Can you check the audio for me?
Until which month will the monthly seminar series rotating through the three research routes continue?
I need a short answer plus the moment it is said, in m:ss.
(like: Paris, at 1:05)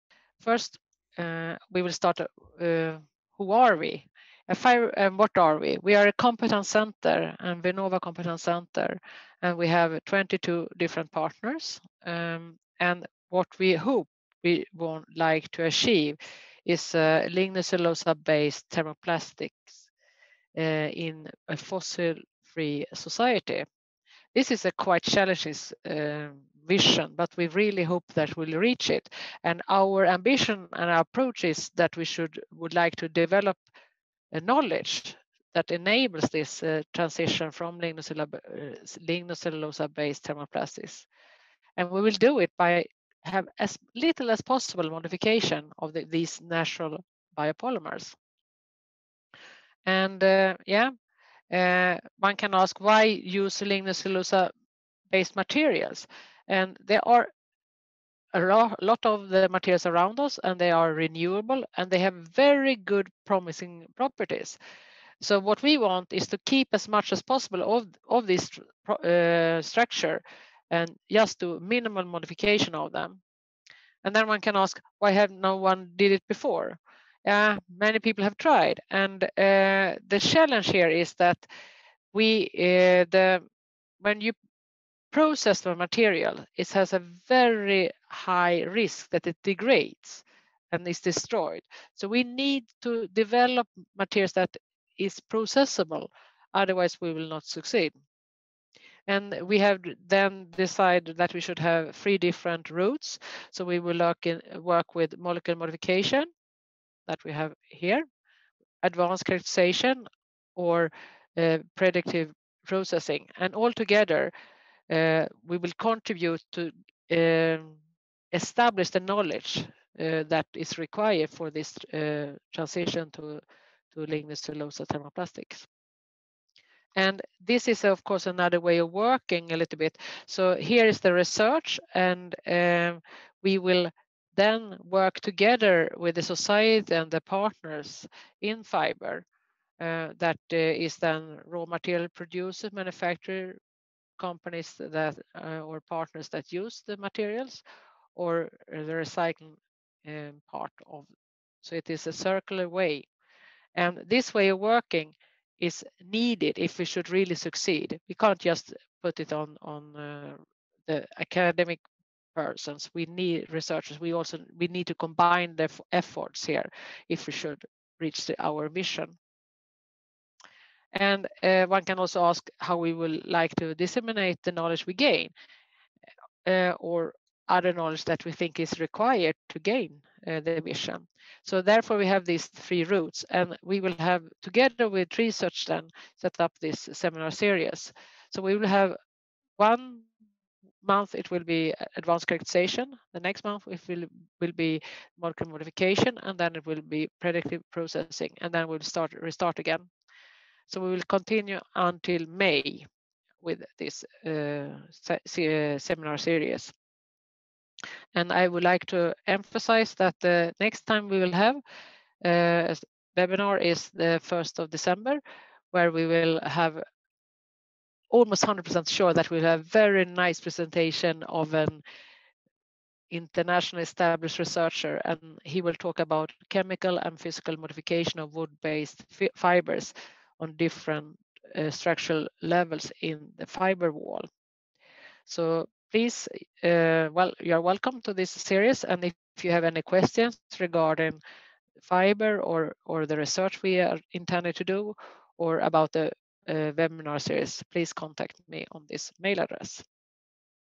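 May, at 3:22.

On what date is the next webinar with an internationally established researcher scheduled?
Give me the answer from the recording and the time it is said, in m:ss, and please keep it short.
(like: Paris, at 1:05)
1st of December, at 3:34.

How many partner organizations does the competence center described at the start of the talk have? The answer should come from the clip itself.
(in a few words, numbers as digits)
22.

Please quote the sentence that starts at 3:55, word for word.
So please, uh, well, you're welcome to this series.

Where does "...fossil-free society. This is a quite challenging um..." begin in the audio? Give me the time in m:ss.
0:21.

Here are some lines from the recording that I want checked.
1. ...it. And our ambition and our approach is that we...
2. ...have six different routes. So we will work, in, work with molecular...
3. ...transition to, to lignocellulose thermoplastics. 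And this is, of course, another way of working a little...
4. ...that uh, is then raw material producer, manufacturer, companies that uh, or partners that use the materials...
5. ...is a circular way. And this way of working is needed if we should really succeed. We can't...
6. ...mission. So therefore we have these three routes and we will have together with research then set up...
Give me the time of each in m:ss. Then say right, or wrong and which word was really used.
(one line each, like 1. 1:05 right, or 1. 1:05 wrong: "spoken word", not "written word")
1. 0:28 right
2. 1:41 wrong: "three", not "six"
3. 2:02 right
4. 2:20 right
5. 2:31 right
6. 3:00 right.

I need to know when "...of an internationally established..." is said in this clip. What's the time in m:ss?
3:41.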